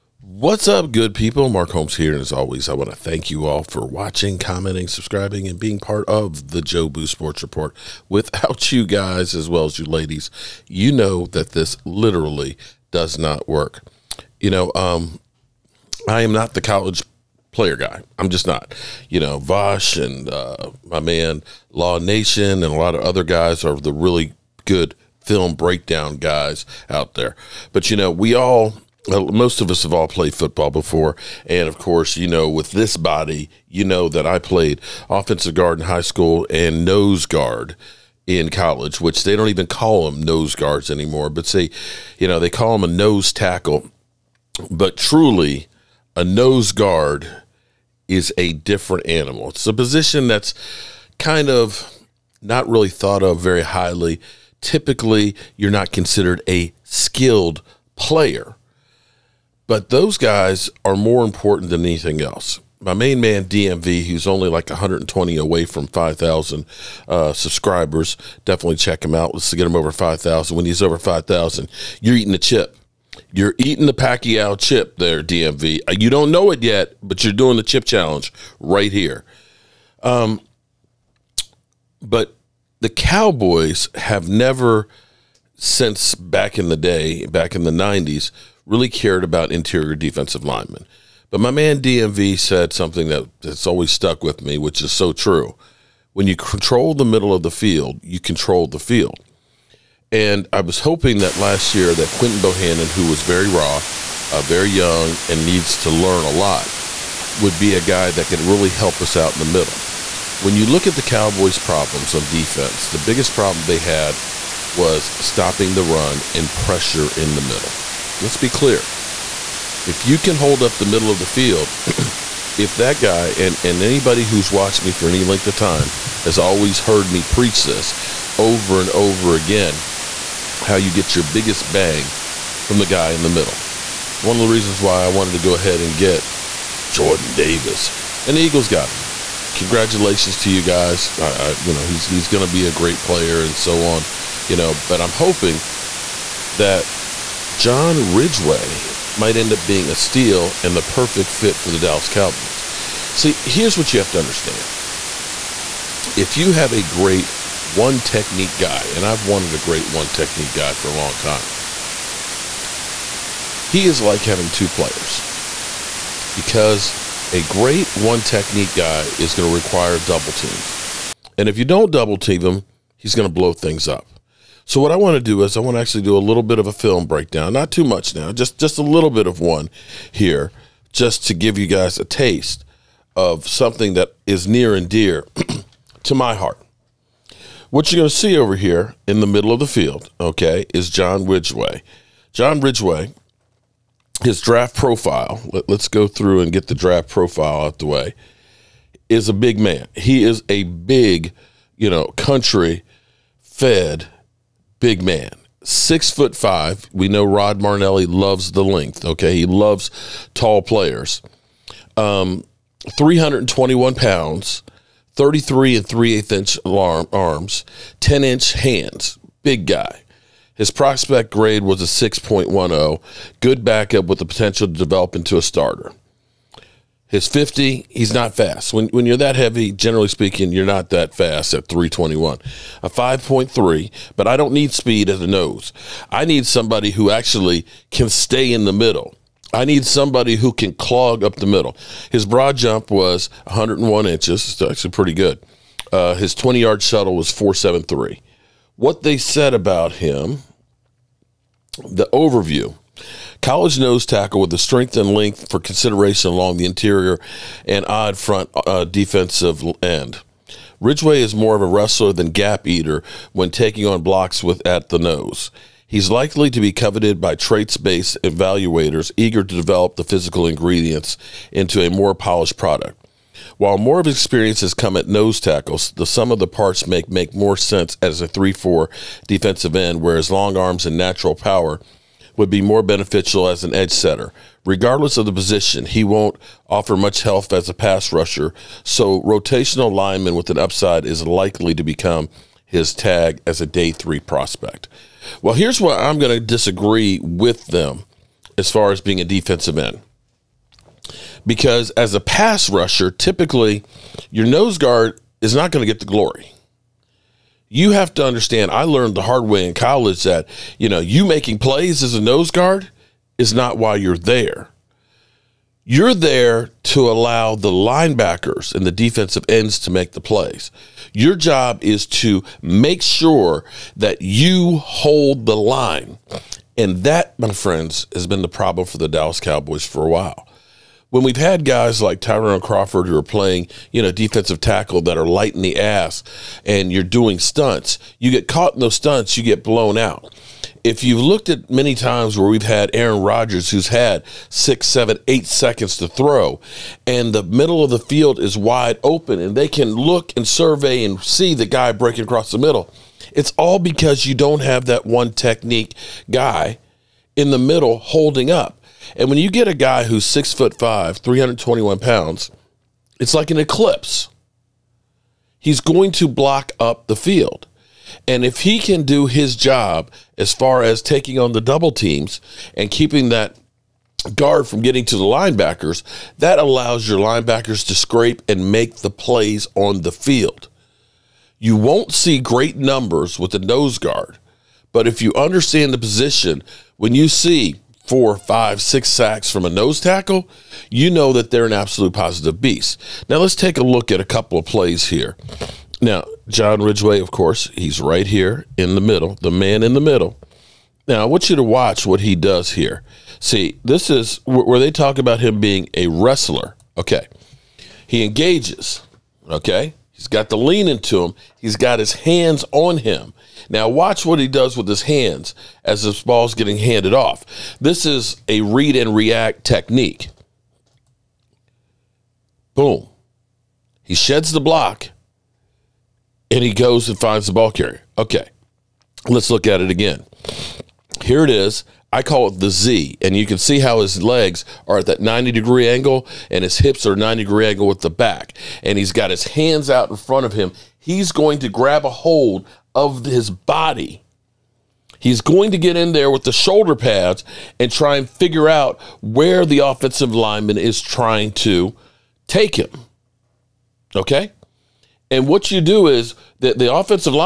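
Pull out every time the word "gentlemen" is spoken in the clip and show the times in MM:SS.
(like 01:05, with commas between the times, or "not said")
not said.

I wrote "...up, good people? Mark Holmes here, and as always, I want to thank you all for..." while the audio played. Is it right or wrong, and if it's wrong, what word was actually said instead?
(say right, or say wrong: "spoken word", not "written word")
right.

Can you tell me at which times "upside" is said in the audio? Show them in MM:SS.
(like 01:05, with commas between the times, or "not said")
04:50.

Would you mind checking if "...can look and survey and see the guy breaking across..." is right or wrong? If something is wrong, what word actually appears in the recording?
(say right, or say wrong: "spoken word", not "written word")
right.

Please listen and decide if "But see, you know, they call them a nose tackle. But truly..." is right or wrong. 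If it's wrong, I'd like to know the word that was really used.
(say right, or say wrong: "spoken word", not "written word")
right.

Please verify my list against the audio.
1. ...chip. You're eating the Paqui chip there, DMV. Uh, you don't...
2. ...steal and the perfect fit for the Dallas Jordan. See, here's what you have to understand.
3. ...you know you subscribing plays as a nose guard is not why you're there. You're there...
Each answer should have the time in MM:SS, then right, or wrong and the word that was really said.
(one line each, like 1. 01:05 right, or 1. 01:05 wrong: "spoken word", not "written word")
1. 01:12 right
2. 02:29 wrong: "Cowboys", not "Jordan"
3. 05:10 wrong: "making", not "subscribing".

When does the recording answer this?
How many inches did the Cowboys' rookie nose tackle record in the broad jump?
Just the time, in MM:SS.
04:03.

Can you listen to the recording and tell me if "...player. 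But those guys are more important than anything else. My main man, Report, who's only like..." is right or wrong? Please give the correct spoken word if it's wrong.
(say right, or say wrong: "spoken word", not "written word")
wrong: "DMV", not "Report".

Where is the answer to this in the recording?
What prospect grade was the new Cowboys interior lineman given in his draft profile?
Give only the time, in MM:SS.
03:41.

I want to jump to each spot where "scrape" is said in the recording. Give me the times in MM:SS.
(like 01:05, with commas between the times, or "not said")
06:17.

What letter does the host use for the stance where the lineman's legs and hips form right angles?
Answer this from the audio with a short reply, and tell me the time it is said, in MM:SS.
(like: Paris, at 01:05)
Z, at 07:12.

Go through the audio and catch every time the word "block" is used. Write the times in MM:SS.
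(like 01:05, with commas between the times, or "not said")
04:24, 06:06, 07:04.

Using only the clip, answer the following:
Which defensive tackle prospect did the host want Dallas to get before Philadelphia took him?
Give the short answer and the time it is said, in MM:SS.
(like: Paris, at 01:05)
Jordan Davis, at 02:16.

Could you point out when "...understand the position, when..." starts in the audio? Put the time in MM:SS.
06:25.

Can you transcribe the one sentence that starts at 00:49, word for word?
It's a position that's kind of not really thought of very highly.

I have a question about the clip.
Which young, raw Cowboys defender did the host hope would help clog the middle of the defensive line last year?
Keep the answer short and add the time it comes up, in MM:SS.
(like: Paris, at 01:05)
Quinton Bohanna, at 01:42.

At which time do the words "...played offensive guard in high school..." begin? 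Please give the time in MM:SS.
00:34.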